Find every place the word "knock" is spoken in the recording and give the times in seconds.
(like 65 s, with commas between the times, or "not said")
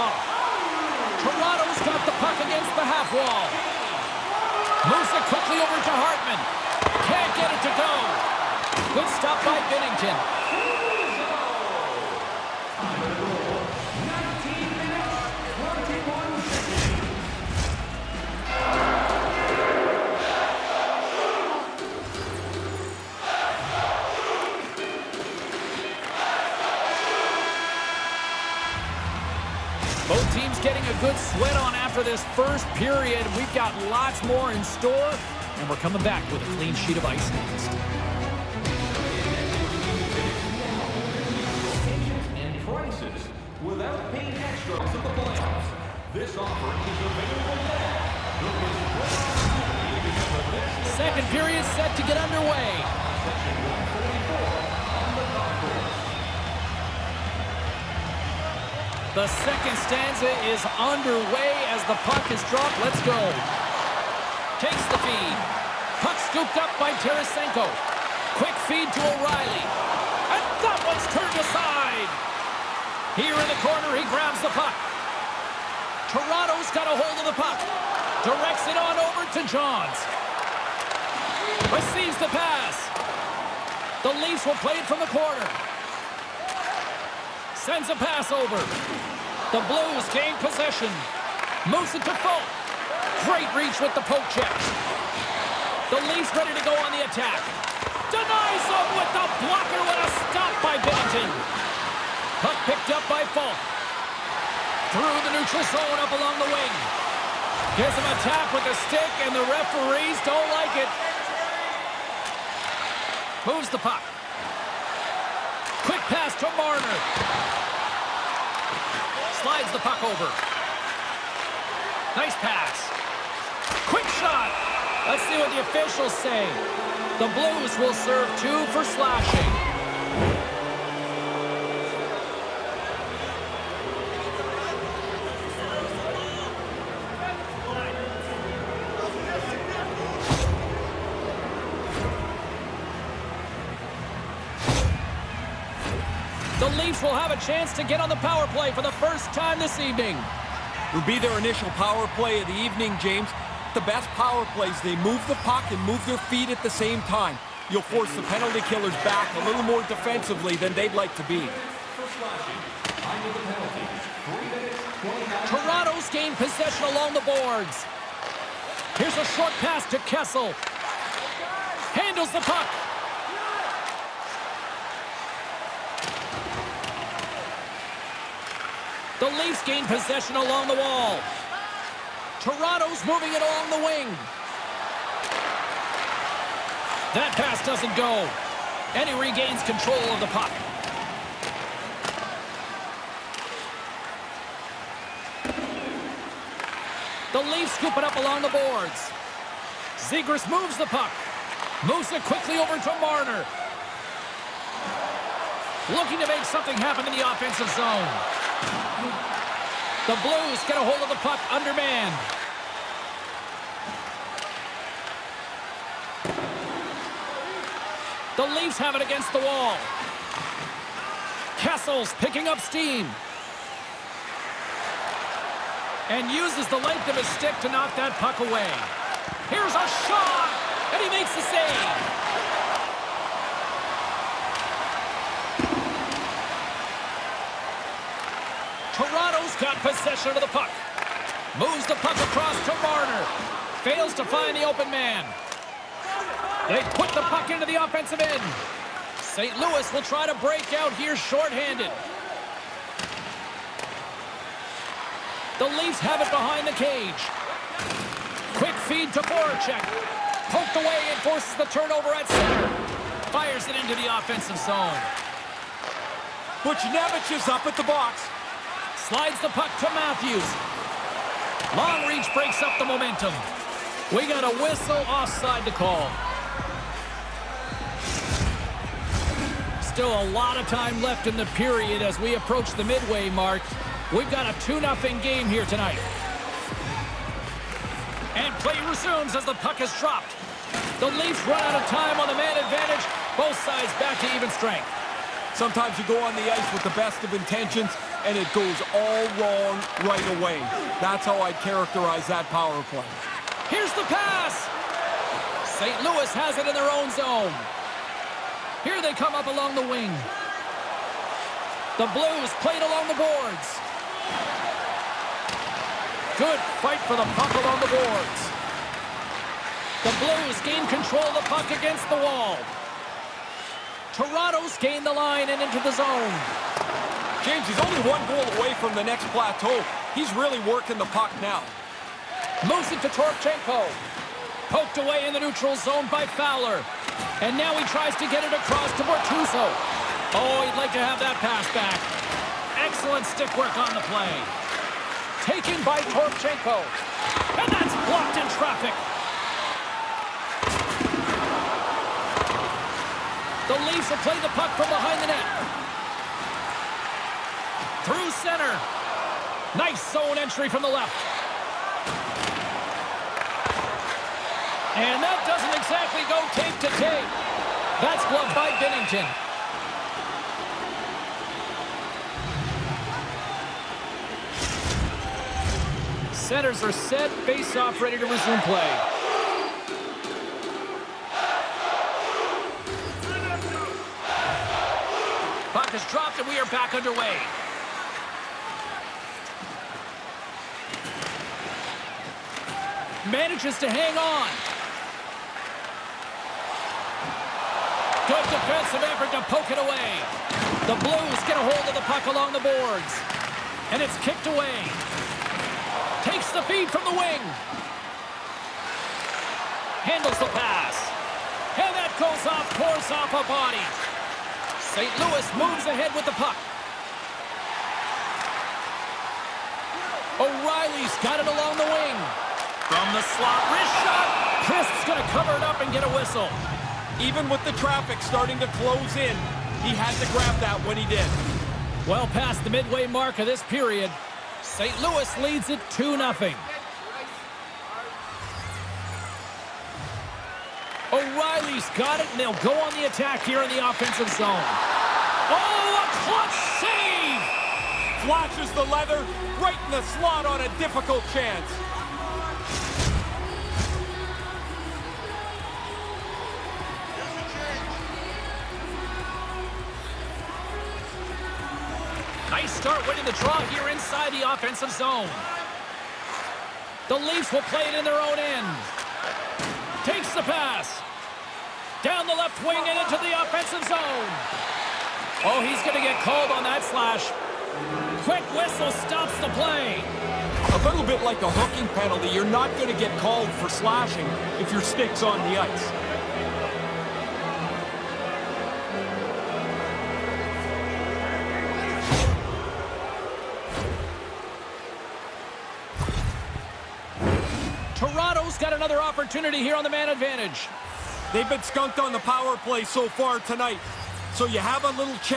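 227 s.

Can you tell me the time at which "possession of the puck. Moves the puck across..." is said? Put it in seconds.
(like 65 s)
239 s.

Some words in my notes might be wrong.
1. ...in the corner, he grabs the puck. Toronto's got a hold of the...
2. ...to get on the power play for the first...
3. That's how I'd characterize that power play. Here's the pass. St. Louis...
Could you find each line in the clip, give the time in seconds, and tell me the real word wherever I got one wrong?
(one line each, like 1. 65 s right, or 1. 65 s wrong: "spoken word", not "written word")
1. 73 s right
2. 147 s right
3. 301 s right.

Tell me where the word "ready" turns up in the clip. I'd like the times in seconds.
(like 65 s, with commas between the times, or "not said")
96 s, 378 s.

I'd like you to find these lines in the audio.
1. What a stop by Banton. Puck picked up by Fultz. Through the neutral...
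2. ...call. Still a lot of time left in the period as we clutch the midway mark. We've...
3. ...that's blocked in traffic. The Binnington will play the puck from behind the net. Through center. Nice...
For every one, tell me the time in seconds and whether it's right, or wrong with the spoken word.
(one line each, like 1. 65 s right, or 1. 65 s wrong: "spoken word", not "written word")
1. 99 s right
2. 275 s wrong: "approach", not "clutch"
3. 347 s wrong: "Leafs", not "Binnington".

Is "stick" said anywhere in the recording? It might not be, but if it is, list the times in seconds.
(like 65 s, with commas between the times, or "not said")
108 s, 227 s, 343 s, 484 s.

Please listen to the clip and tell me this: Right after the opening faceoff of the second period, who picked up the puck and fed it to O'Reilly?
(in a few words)
Tarasenko.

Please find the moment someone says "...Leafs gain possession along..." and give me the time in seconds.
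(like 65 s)
179 s.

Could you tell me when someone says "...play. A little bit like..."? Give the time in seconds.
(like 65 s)
479 s.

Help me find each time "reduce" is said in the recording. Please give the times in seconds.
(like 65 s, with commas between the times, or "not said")
not said.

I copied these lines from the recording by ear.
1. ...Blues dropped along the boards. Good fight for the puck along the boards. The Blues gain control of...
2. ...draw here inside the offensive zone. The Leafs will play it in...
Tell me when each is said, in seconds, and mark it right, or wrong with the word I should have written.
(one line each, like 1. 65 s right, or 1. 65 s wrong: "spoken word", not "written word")
1. 312 s wrong: "played", not "dropped"
2. 463 s right.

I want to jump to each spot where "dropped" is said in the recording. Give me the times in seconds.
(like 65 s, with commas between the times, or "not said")
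62 s, 289 s, 386 s.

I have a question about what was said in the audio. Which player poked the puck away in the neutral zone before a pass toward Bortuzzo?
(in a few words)
Fowler.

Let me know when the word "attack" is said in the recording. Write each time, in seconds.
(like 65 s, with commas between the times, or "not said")
97 s, 443 s.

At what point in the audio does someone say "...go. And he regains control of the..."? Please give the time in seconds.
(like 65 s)
187 s.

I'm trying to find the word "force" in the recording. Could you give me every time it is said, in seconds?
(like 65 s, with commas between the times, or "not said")
157 s, 261 s.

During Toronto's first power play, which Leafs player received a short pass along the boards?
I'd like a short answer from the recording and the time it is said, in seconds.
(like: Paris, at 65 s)
Kessel, at 168 s.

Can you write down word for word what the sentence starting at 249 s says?
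Louis will try to break out here shorthanded.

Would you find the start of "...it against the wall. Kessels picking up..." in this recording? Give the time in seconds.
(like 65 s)
218 s.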